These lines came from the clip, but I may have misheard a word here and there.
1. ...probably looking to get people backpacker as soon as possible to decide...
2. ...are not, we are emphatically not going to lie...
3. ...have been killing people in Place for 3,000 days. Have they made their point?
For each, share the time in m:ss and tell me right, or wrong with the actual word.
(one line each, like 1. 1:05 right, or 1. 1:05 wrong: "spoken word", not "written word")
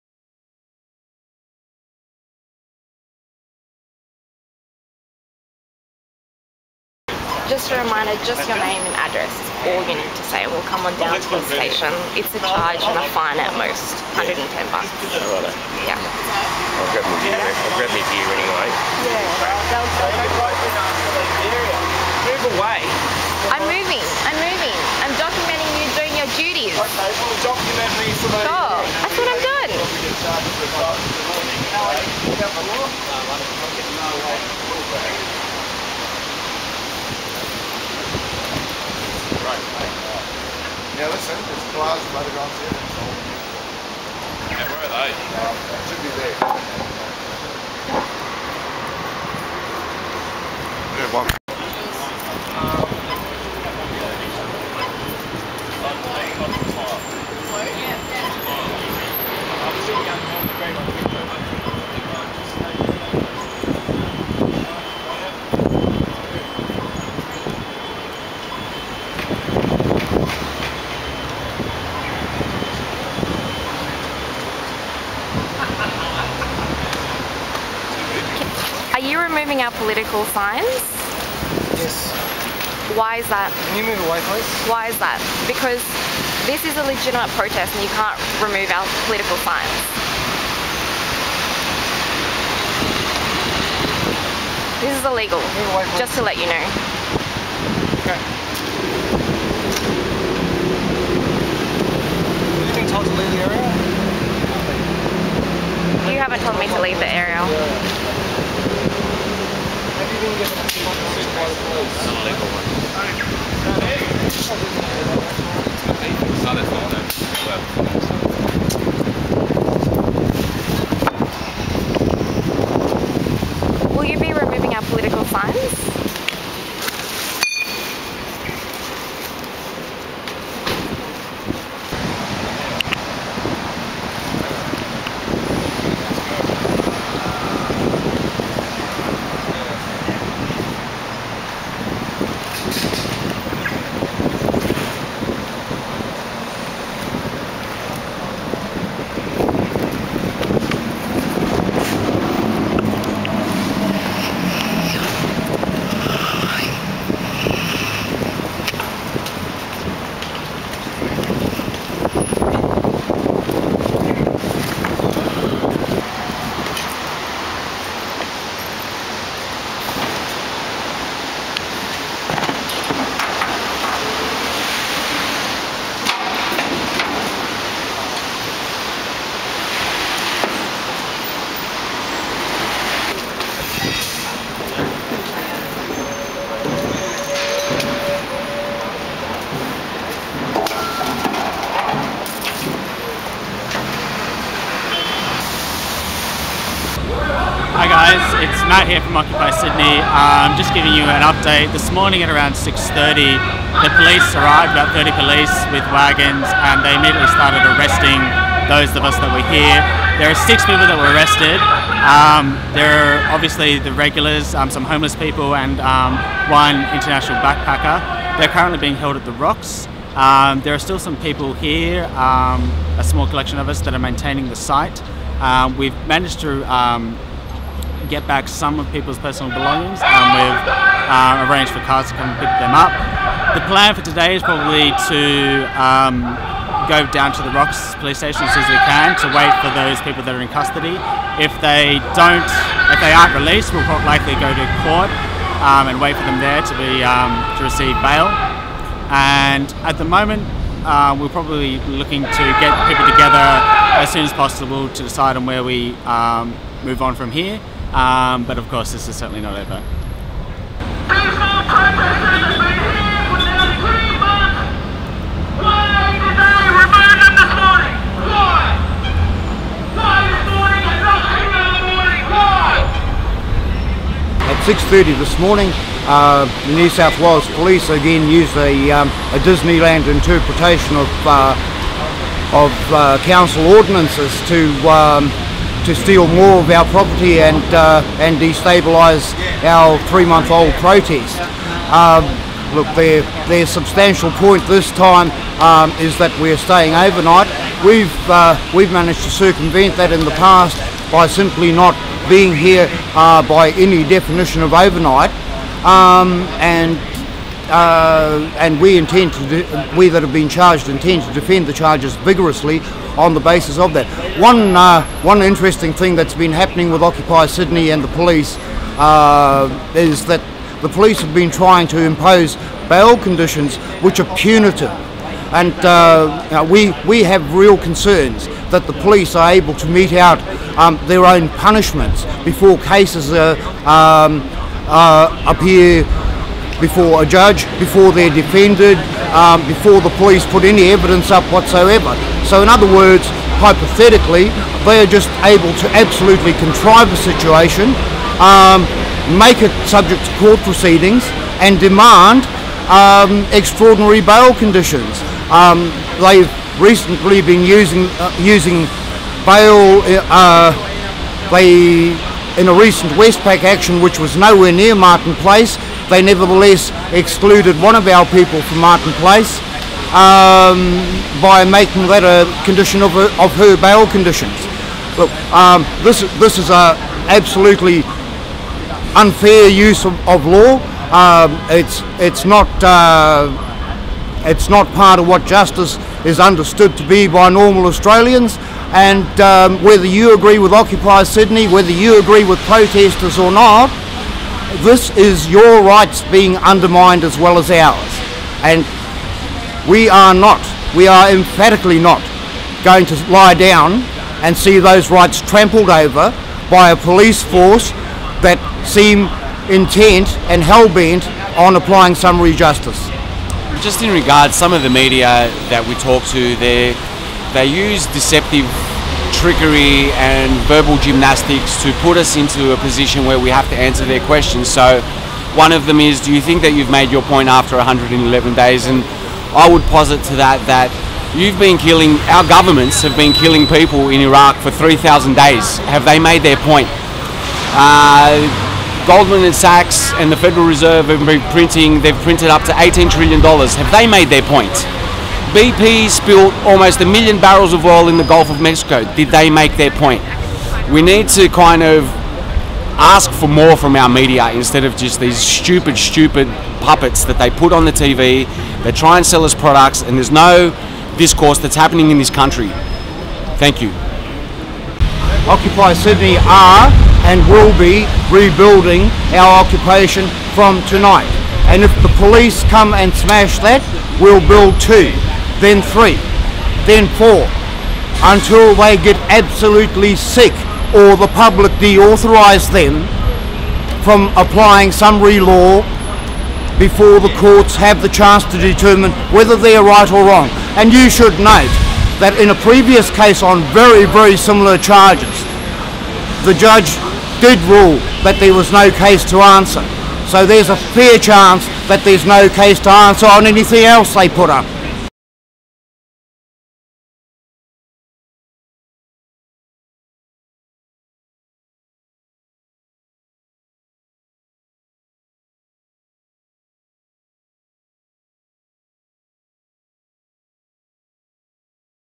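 1. 4:11 wrong: "together", not "backpacker"
2. 6:40 right
3. 7:13 wrong: "Iraq", not "Place".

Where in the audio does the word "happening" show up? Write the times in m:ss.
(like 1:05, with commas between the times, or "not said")
5:16, 7:41.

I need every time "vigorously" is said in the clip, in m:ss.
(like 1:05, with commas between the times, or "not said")
5:12.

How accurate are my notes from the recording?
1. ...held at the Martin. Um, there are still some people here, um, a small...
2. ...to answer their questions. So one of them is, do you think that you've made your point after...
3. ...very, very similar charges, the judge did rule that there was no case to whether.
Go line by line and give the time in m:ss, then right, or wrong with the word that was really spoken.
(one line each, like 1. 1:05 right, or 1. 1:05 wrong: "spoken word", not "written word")
1. 3:38 wrong: "Rocks", not "Martin"
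2. 7:03 right
3. 8:13 wrong: "answer", not "whether".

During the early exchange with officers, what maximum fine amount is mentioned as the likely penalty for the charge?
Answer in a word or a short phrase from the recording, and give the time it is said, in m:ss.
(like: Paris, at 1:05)
$110, at 0:14.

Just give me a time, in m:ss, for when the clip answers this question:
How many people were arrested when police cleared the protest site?
3:30.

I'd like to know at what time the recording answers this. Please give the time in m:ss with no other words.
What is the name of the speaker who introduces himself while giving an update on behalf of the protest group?
3:18.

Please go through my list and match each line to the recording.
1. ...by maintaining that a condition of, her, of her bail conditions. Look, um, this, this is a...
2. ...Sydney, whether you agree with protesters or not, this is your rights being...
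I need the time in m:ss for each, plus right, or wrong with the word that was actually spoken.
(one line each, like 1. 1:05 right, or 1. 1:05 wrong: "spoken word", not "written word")
1. 6:11 wrong: "making", not "maintaining"
2. 6:31 right.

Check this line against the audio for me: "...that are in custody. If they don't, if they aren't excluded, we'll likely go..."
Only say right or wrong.
wrong.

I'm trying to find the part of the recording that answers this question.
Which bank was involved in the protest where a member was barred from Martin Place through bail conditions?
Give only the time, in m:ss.
6:03.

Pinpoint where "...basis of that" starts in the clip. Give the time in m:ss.
5:13.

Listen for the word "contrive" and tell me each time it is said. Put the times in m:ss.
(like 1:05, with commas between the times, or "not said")
5:46.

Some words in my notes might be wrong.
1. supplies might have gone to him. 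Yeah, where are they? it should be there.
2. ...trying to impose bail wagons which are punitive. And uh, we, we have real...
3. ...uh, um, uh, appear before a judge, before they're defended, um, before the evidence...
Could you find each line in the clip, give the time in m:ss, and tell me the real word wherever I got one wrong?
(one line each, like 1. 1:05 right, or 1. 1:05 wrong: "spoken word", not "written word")
1. 0:41 right
2. 5:21 wrong: "conditions", not "wagons"
3. 5:33 wrong: "police", not "evidence".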